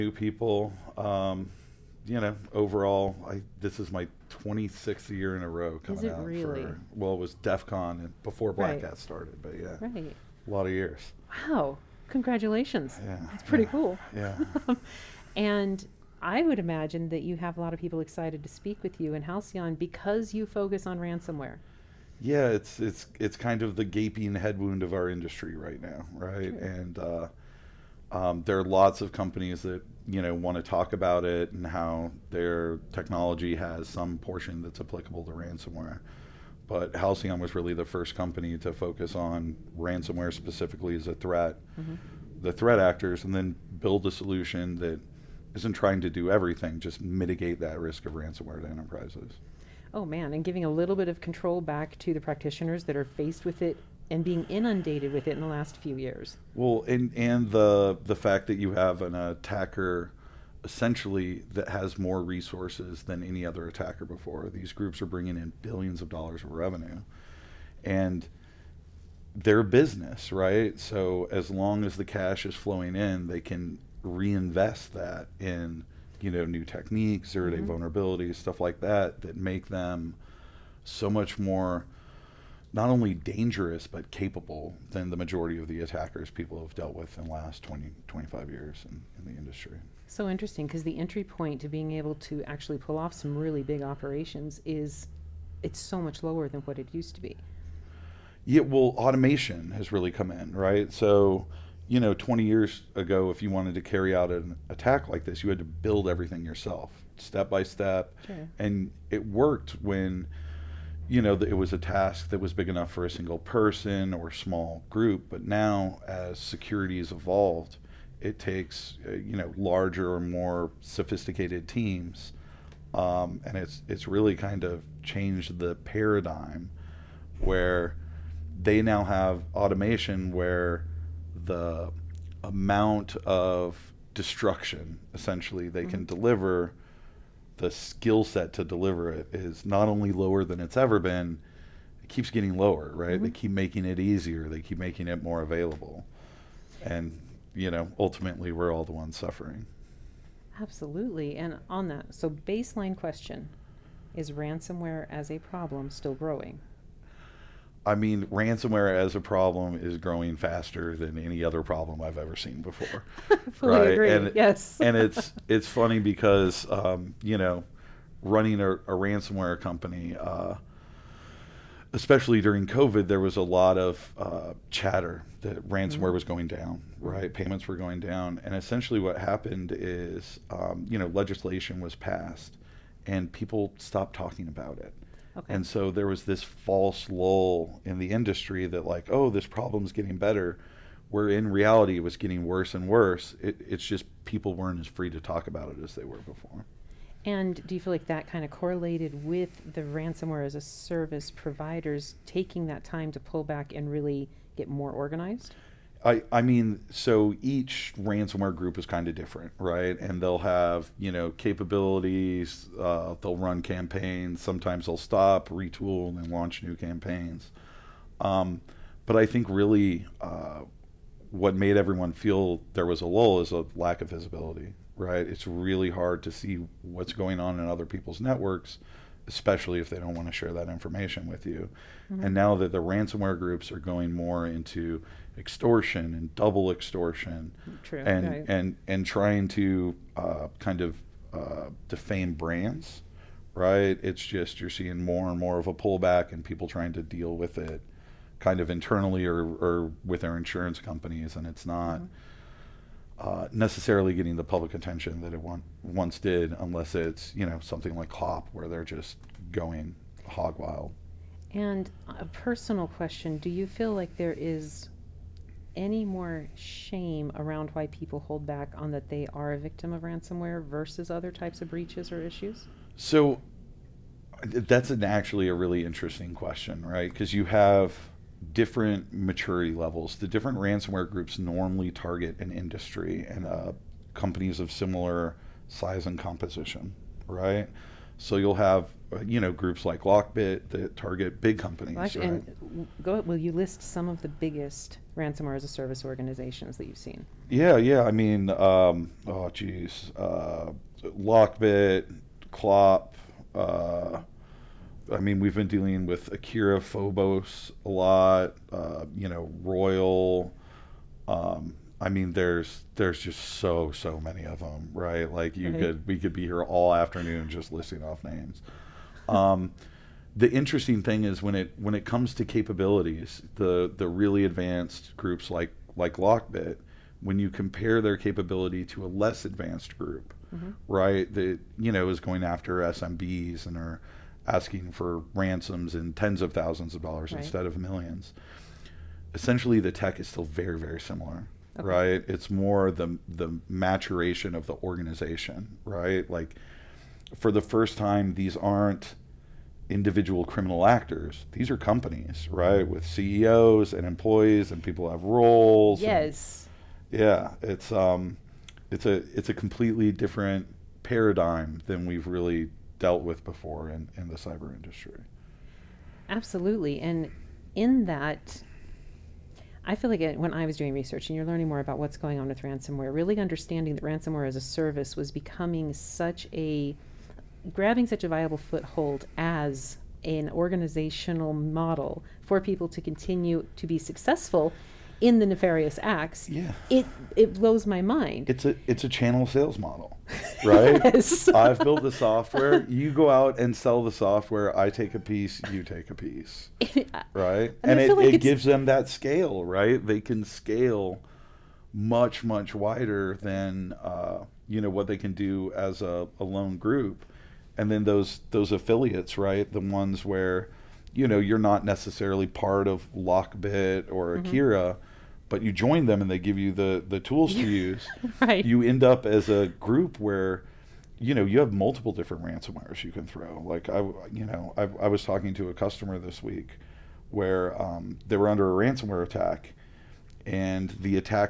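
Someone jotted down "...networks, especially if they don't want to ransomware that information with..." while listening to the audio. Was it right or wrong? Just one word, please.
wrong.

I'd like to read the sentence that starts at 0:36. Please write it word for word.
But Halcyon was really the first company to focus on ransomware specifically as a threat, mm-hmm.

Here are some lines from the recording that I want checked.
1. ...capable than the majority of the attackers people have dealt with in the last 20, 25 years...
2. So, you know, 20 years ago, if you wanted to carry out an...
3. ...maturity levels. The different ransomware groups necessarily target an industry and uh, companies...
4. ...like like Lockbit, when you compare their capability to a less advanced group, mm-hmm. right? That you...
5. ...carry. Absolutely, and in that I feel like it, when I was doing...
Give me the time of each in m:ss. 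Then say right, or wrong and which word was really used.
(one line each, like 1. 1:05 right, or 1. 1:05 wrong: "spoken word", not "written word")
1. 1:24 right
2. 1:40 right
3. 4:39 wrong: "normally", not "necessarily"
4. 5:25 right
5. 6:04 wrong: "industry", not "carry".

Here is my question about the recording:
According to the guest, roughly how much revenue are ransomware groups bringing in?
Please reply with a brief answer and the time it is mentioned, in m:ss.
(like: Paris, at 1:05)
billions of dollars, at 1:05.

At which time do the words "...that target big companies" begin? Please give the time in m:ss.
4:50.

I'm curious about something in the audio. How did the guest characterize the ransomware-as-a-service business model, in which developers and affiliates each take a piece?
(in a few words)
a channel sales model.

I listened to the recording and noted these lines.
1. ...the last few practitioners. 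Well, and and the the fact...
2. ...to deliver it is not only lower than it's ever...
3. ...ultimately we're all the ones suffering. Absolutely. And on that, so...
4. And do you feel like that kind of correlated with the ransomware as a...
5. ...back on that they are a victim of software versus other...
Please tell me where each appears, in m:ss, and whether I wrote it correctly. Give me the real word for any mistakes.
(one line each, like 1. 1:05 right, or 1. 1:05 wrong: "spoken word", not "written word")
1. 0:55 wrong: "years", not "practitioners"
2. 2:18 right
3. 2:27 right
4. 3:17 right
5. 4:28 wrong: "ransomware", not "software".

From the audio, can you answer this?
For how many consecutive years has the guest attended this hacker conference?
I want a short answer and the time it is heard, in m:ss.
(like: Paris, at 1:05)
26, at 0:04.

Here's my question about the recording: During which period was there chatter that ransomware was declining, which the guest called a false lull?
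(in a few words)
COVID.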